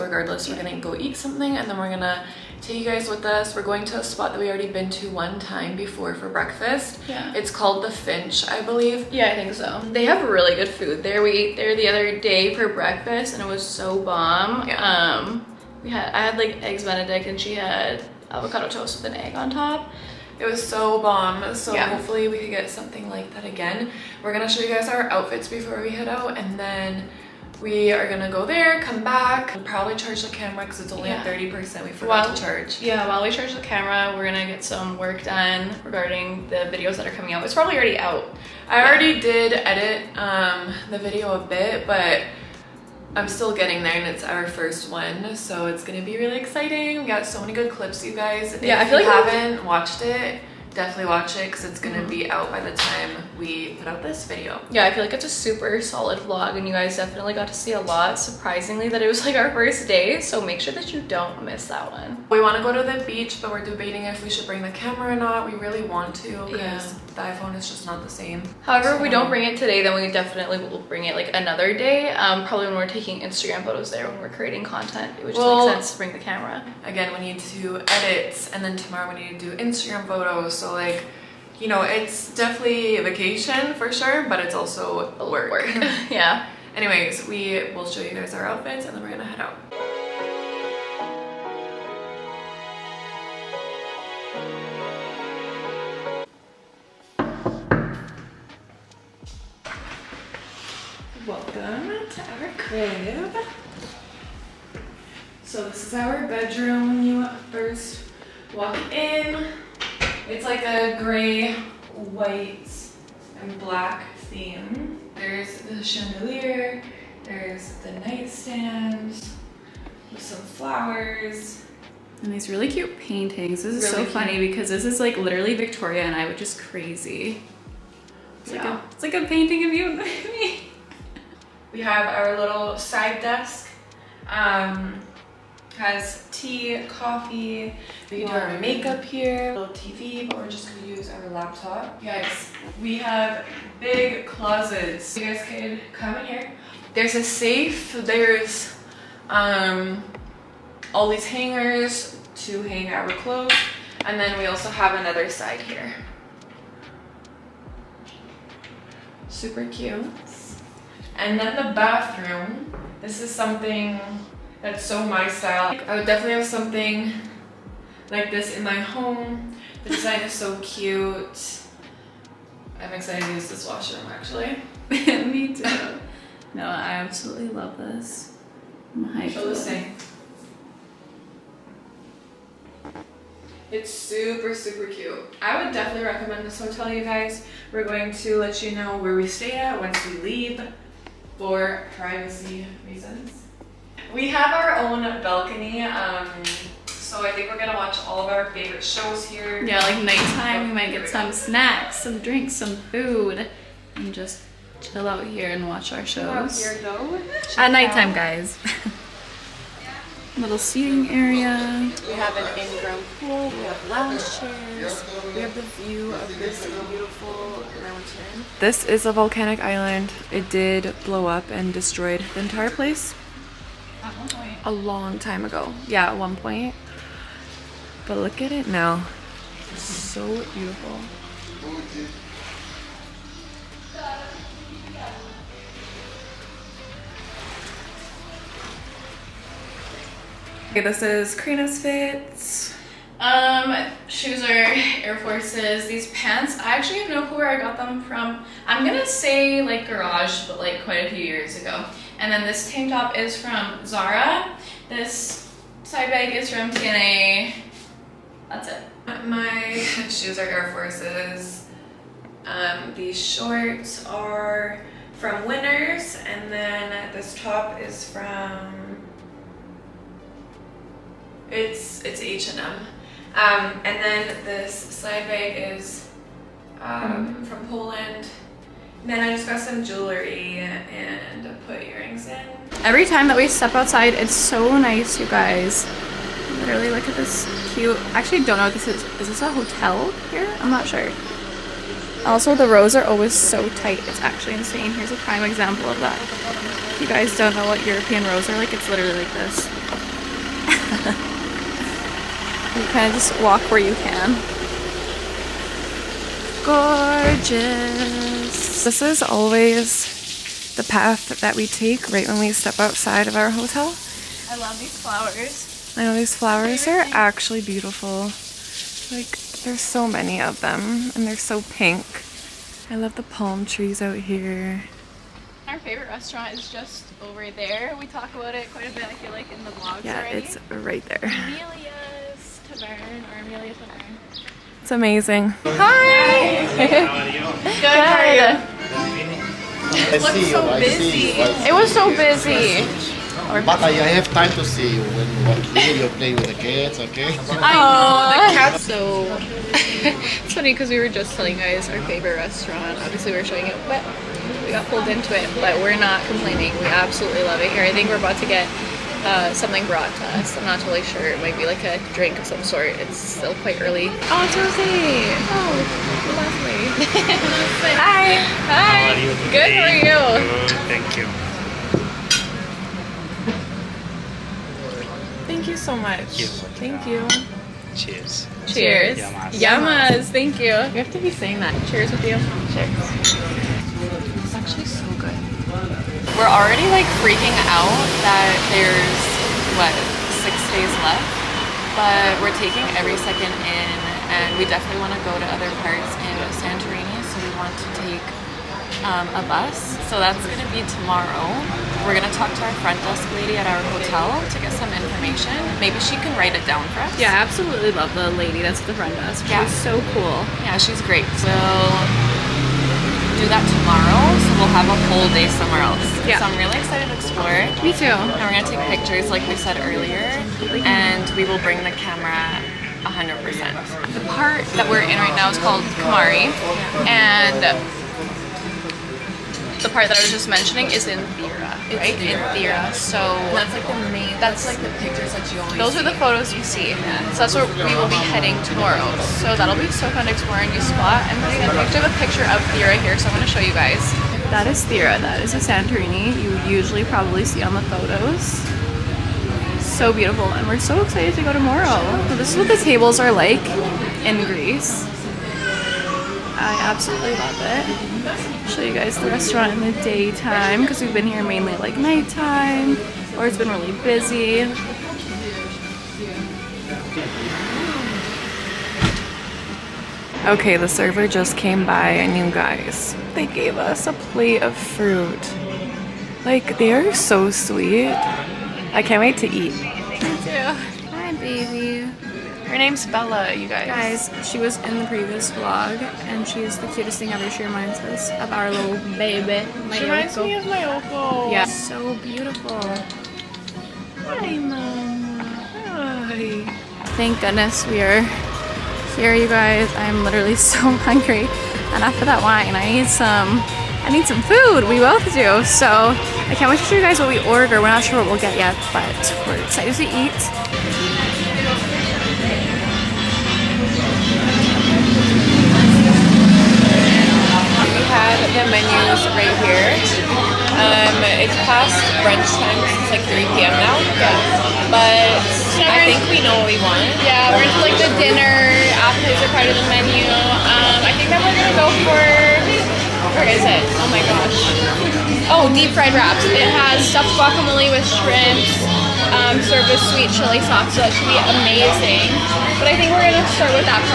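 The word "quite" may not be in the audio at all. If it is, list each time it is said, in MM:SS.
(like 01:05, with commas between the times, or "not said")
04:10, 05:28, 06:03.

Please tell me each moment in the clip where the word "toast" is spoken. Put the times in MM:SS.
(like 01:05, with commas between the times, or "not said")
00:18.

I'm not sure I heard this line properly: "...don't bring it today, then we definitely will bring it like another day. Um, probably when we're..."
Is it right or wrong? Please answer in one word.
right.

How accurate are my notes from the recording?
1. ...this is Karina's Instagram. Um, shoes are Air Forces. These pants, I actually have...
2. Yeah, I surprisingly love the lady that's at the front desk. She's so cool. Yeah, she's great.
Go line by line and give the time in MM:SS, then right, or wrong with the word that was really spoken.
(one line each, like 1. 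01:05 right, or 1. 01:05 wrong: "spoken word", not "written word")
1. 04:00 wrong: "Fits", not "Instagram"
2. 06:47 wrong: "absolutely", not "surprisingly".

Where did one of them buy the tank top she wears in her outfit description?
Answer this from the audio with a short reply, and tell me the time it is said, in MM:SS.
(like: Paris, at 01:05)
Zara, at 04:13.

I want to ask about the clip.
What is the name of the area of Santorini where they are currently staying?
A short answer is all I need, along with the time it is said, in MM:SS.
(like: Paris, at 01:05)
Kamari, at 07:05.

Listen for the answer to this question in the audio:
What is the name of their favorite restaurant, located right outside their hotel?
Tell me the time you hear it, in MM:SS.
05:31.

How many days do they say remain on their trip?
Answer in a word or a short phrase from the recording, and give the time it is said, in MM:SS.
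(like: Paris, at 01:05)
6, at 06:30.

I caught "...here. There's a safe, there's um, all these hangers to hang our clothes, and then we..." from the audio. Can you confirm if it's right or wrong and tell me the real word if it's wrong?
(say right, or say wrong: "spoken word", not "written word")
right.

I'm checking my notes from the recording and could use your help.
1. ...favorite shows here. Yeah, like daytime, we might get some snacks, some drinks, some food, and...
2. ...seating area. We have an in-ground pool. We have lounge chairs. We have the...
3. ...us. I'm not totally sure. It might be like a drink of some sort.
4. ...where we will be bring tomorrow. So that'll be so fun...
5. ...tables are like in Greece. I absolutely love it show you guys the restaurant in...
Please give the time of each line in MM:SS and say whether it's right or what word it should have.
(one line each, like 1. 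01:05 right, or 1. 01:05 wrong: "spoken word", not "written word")
1. 03:18 wrong: "nighttime", not "daytime"
2. 03:30 right
3. 06:00 right
4. 07:17 wrong: "heading", not "bring"
5. 07:32 right.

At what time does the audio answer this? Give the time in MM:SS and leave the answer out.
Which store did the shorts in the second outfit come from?
04:25.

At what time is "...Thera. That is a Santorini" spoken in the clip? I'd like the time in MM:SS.
07:24.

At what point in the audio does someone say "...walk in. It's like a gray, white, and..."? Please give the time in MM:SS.
01:48.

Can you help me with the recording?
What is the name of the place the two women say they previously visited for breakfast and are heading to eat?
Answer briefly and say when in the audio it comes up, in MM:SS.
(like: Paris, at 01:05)
The Finch, at 00:07.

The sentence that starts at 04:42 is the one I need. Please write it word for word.
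Every time that we step outside, it's so nice, you guys.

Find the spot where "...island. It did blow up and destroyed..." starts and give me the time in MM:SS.
03:39.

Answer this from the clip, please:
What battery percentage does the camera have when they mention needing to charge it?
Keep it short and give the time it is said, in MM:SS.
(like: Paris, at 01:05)
30%, at 00:31.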